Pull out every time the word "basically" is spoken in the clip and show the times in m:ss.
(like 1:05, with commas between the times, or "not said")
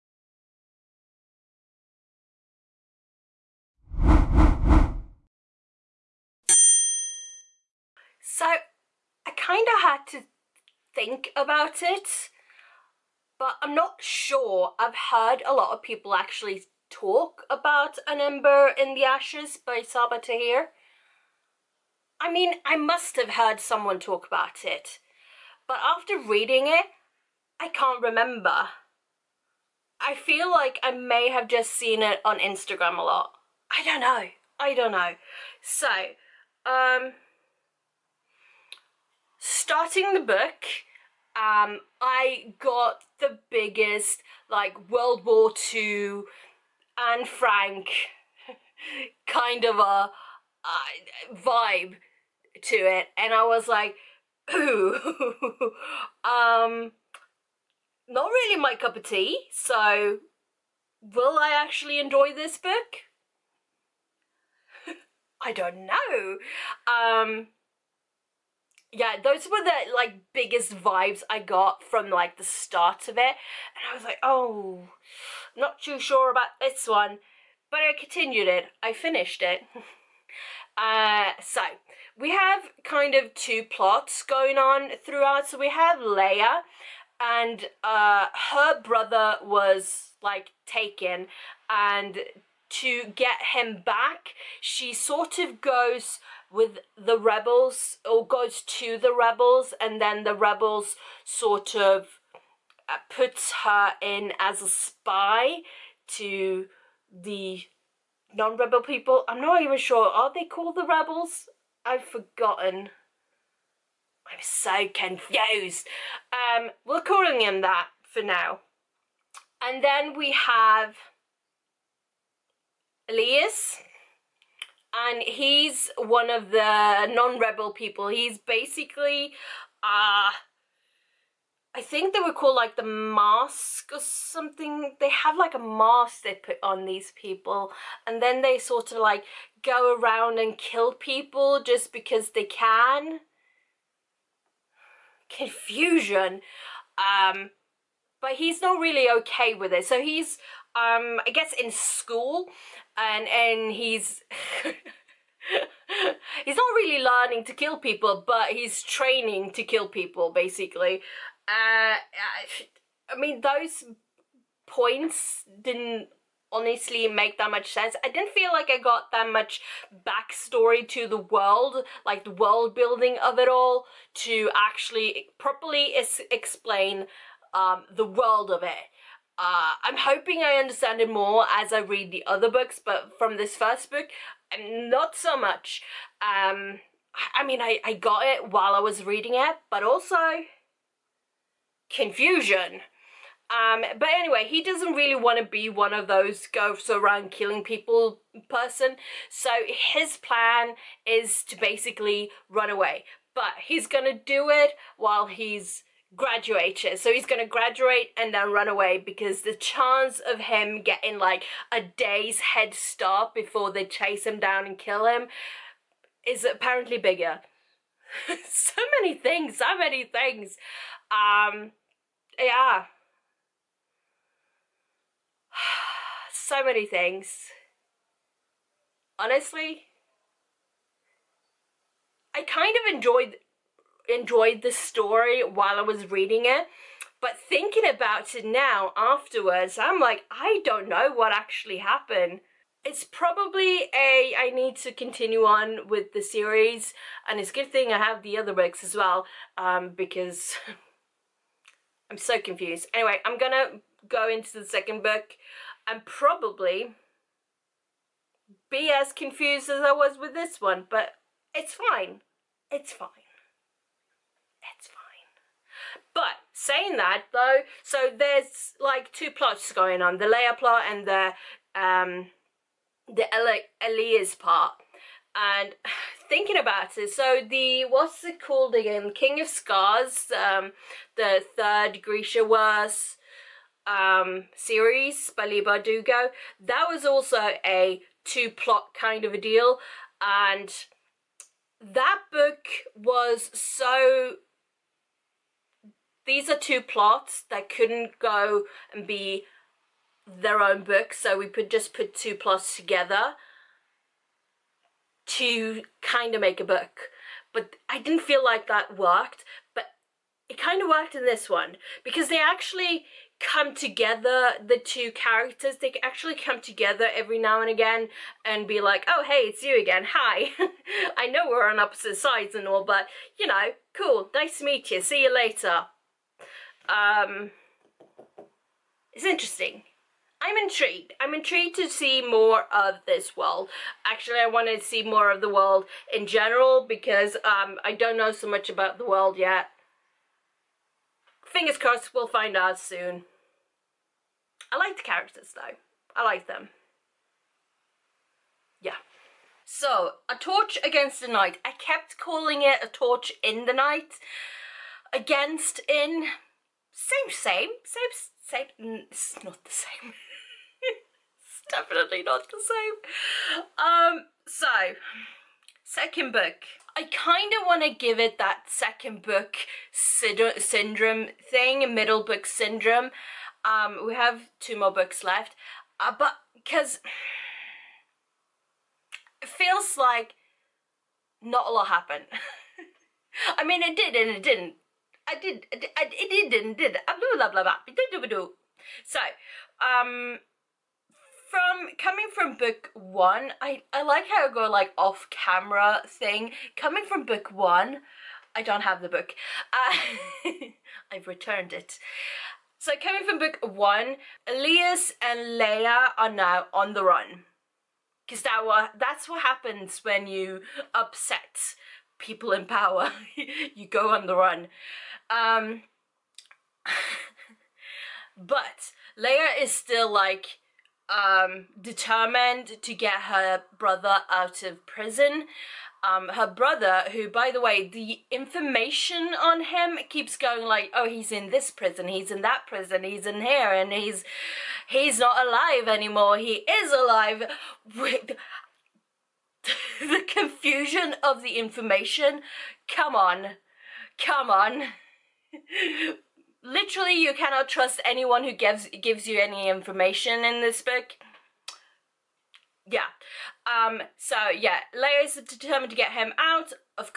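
2:08, 2:40, 3:21.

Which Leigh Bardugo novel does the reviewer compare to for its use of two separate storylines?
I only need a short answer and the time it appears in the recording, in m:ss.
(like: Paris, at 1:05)
King of Scars, at 4:39.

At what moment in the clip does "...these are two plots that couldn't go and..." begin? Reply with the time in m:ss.
4:56.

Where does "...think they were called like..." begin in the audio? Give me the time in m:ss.
2:11.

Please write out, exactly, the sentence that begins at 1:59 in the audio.
And then we have Elias and he's one of the non-rebel people.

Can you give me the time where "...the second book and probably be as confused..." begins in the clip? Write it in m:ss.
4:14.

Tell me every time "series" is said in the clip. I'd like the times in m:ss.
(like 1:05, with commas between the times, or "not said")
4:06, 4:44.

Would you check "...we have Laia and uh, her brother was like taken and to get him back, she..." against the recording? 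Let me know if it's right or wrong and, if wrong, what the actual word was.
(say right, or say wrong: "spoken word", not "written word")
right.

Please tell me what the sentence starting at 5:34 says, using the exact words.
Actually, I want to see more of the world in general because um, I don't know so much about the world yet.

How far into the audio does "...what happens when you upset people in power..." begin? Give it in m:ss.
6:49.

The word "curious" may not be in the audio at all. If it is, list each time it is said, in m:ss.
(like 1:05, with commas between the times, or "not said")
not said.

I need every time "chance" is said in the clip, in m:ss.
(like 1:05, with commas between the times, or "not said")
3:29.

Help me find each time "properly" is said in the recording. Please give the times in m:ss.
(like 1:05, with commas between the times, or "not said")
2:55.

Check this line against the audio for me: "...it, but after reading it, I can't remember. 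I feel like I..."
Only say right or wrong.
right.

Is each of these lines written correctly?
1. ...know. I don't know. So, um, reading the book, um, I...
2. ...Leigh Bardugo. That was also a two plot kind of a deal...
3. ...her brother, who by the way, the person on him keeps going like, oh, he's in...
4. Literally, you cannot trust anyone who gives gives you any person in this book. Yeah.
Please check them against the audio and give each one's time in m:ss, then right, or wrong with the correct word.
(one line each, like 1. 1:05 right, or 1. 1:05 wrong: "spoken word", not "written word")
1. 0:34 wrong: "starting", not "reading"
2. 4:45 right
3. 7:06 wrong: "information", not "person"
4. 7:26 wrong: "information", not "person".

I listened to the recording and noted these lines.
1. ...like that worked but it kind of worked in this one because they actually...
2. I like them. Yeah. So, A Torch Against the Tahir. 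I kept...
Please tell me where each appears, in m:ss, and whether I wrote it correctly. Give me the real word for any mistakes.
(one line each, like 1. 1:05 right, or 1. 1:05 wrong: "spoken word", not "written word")
1. 5:08 right
2. 5:46 wrong: "Night", not "Tahir".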